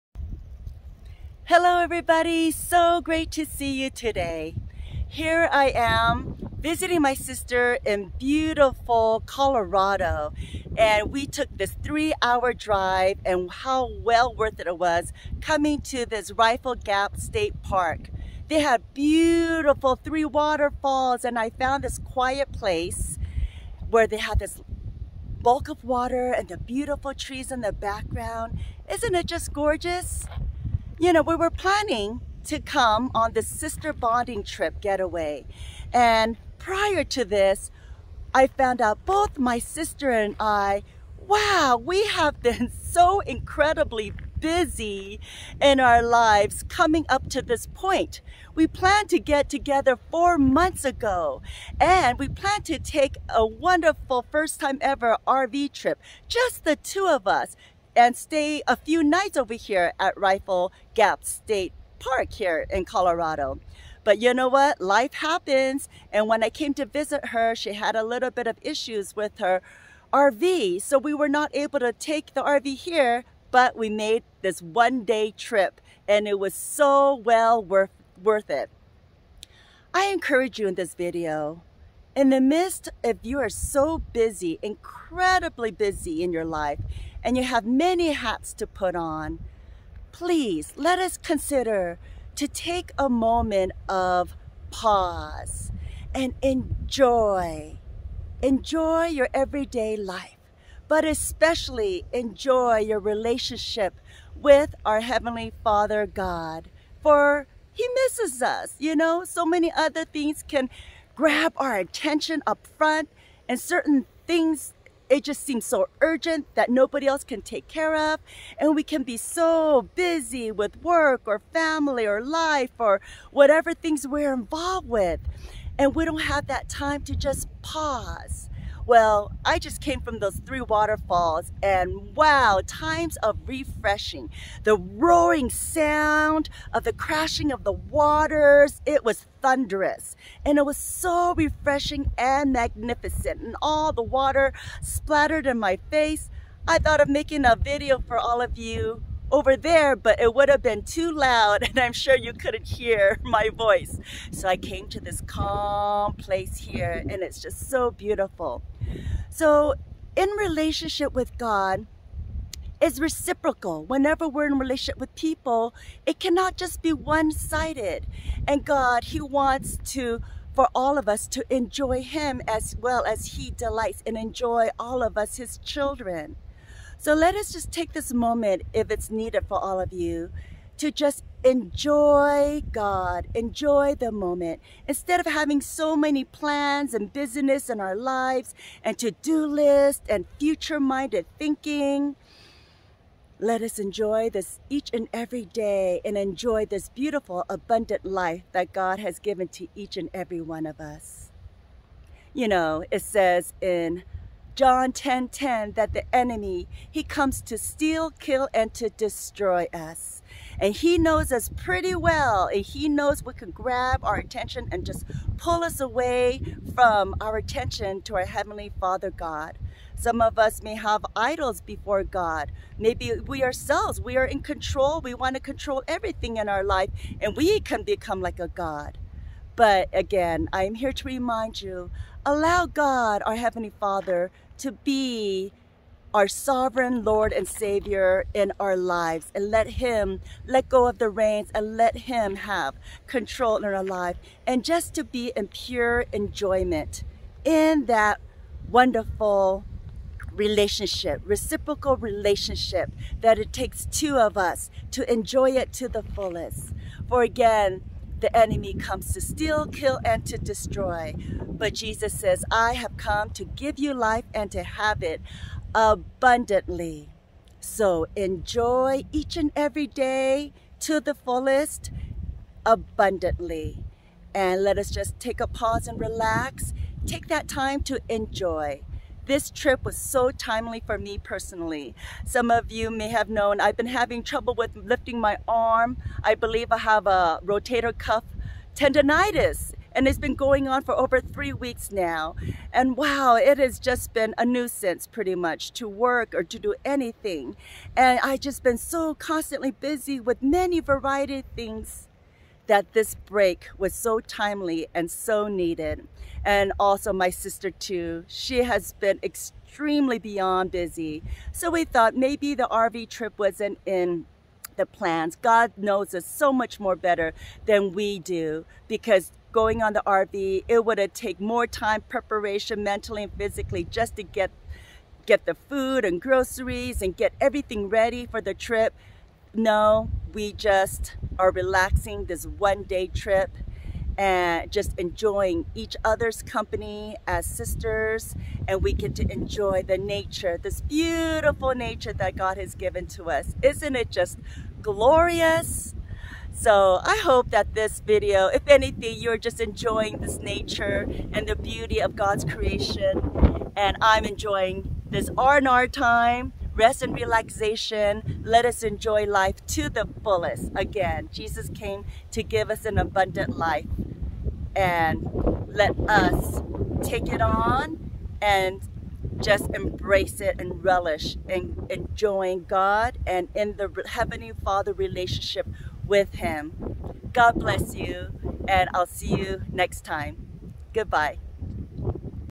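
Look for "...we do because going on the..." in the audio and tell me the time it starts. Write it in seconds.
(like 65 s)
317 s.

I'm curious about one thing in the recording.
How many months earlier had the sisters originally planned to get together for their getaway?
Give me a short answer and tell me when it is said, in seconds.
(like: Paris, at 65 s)
4 months, at 50 s.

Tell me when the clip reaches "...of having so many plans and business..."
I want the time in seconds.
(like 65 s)
185 s.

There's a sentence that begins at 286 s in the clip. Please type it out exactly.
I believe I have a rotator cuff tendonitis and it's been going on for over three weeks now.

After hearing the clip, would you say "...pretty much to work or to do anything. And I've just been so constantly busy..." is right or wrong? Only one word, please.
right.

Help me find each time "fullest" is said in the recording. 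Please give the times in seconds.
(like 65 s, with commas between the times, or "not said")
256 s, 271 s, 360 s.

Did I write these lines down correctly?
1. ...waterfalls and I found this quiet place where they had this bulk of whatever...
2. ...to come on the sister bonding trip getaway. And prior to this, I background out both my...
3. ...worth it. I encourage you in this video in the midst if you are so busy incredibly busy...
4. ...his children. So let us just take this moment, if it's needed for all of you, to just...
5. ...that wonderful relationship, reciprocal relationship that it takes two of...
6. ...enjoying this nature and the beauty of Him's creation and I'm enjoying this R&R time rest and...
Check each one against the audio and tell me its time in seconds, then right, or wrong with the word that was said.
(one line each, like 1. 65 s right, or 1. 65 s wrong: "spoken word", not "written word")
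1. 20 s wrong: "water", not "whatever"
2. 32 s wrong: "found", not "background"
3. 78 s right
4. 175 s right
5. 247 s right
6. 349 s wrong: "God", not "Him".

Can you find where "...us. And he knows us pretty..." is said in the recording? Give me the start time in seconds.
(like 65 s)
209 s.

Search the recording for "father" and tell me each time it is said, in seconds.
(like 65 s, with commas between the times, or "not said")
105 s, 218 s, 233 s, 374 s.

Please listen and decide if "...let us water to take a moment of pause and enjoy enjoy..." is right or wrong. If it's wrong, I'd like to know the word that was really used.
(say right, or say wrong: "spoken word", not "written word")
wrong: "consider", not "water".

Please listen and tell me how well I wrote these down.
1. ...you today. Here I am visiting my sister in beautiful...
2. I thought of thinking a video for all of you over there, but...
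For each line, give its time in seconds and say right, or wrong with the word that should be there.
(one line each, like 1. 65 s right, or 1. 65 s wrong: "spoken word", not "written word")
1. 3 s right
2. 146 s wrong: "making", not "thinking".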